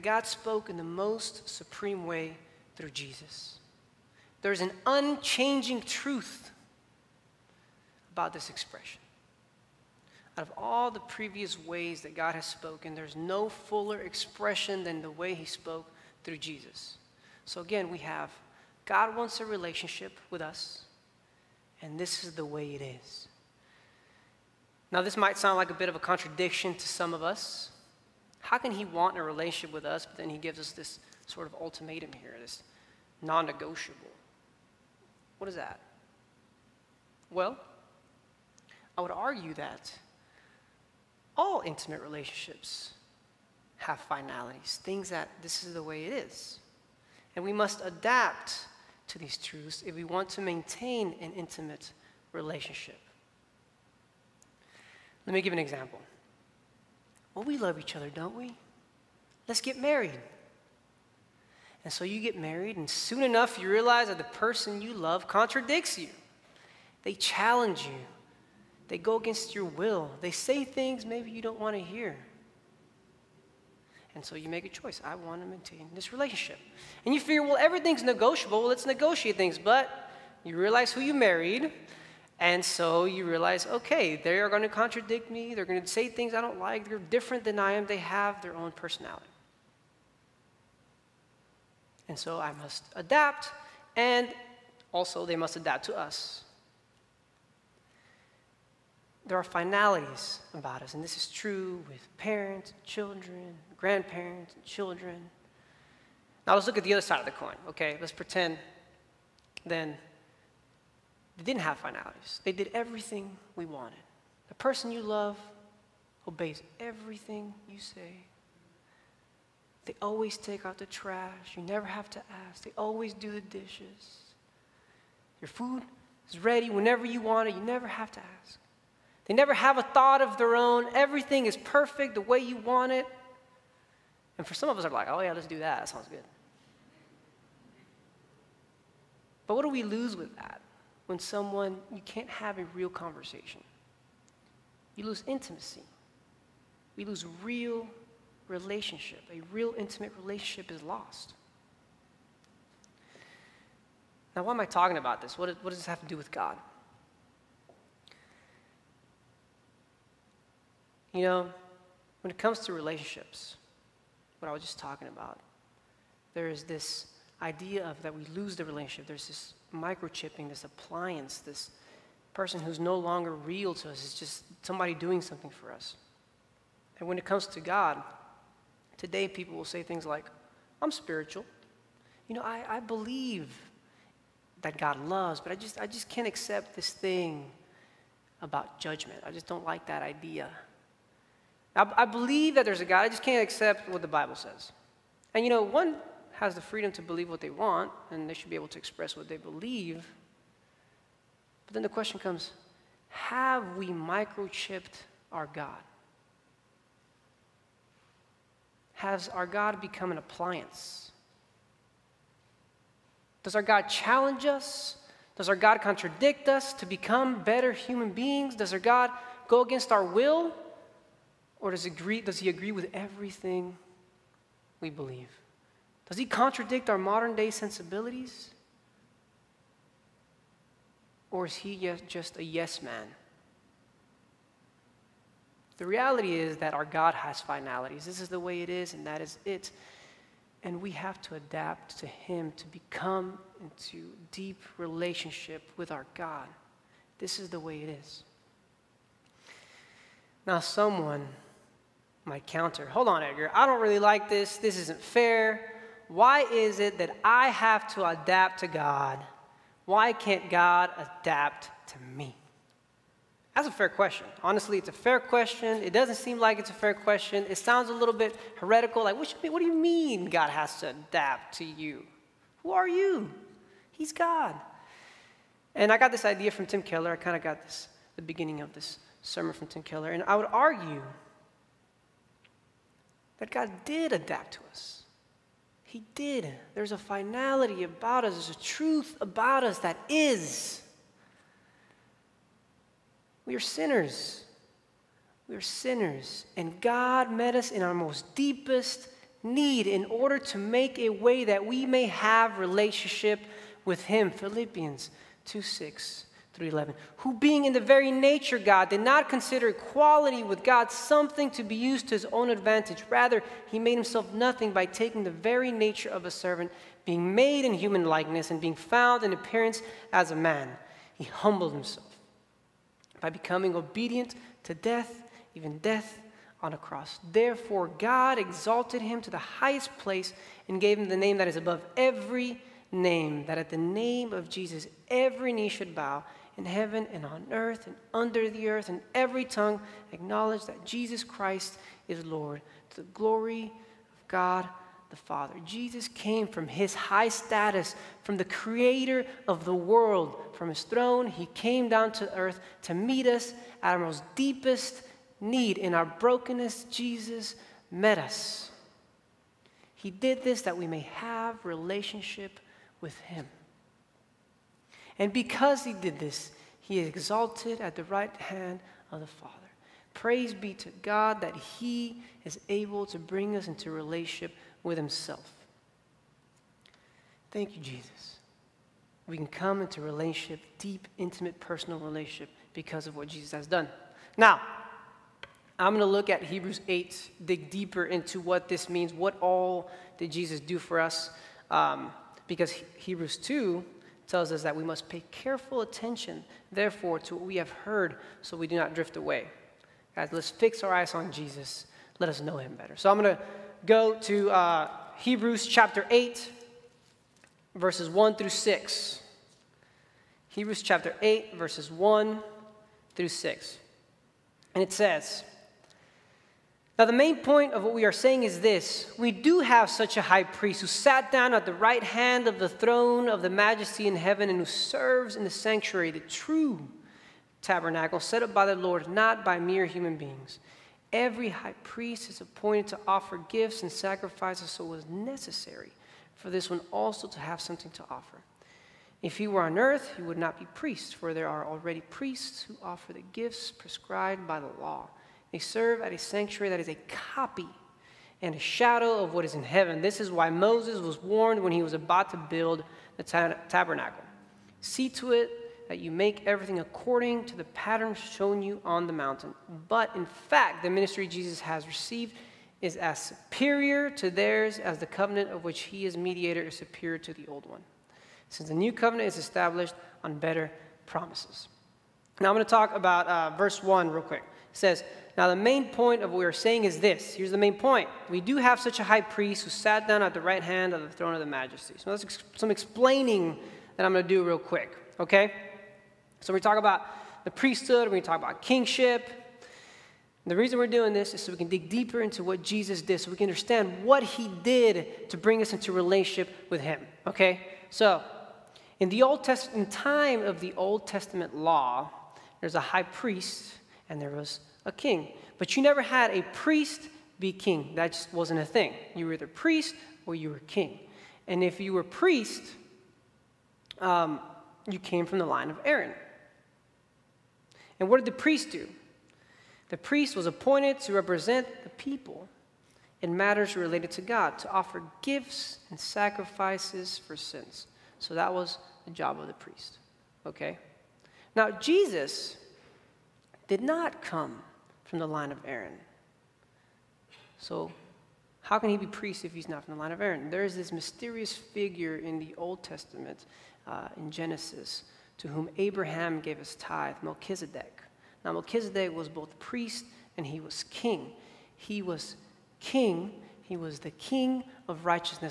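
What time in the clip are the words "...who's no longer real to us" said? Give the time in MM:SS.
02:52.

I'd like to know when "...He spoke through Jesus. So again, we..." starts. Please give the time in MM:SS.
00:15.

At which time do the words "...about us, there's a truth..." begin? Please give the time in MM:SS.
04:47.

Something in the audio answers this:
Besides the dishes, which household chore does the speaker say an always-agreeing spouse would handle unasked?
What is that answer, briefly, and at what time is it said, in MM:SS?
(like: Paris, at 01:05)
Take out the trash, at 02:00.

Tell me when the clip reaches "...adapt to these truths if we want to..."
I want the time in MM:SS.
00:47.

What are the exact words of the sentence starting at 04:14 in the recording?
This isn't fair why is it that I have to adapt to God?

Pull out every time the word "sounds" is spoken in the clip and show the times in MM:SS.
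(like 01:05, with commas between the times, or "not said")
00:25, 02:15, 04:27.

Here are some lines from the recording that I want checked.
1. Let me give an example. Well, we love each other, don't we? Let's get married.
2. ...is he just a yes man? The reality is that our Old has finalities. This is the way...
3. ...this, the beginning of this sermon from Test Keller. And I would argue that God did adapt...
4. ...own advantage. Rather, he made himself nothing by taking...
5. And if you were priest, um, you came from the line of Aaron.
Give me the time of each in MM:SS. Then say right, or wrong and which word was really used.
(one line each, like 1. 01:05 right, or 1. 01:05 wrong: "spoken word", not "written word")
1. 00:55 right
2. 03:51 wrong: "God", not "Old"
3. 04:37 wrong: "Tim", not "Test"
4. 05:12 right
5. 08:31 right.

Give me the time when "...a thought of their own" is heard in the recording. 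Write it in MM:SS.
02:09.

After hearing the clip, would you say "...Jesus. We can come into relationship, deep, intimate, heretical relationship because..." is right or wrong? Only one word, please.
wrong.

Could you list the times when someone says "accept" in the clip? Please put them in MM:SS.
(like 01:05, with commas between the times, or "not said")
03:06, 03:13.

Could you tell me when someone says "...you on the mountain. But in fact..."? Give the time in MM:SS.
07:38.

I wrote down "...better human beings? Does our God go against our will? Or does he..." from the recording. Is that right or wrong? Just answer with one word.
right.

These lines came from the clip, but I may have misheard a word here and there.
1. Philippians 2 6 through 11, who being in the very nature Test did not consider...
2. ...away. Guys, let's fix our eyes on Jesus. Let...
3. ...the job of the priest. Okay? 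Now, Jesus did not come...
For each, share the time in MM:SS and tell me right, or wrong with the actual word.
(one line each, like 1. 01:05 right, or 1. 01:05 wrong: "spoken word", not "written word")
1. 05:04 wrong: "God", not "Test"
2. 06:39 right
3. 08:49 right.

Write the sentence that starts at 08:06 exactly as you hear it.
So we talk about the priesthood, we talk about kingship.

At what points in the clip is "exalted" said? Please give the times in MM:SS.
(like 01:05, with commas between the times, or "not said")
05:28, 06:07.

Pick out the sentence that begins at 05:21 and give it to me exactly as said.
He humbled himself by becoming obedient to death, even death on a cross.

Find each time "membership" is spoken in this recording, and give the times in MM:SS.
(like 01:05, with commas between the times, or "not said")
not said.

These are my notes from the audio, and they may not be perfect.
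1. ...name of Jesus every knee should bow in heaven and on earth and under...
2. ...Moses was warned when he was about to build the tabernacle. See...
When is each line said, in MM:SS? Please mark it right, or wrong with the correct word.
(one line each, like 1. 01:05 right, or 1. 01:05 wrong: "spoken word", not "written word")
1. 05:33 right
2. 07:30 right.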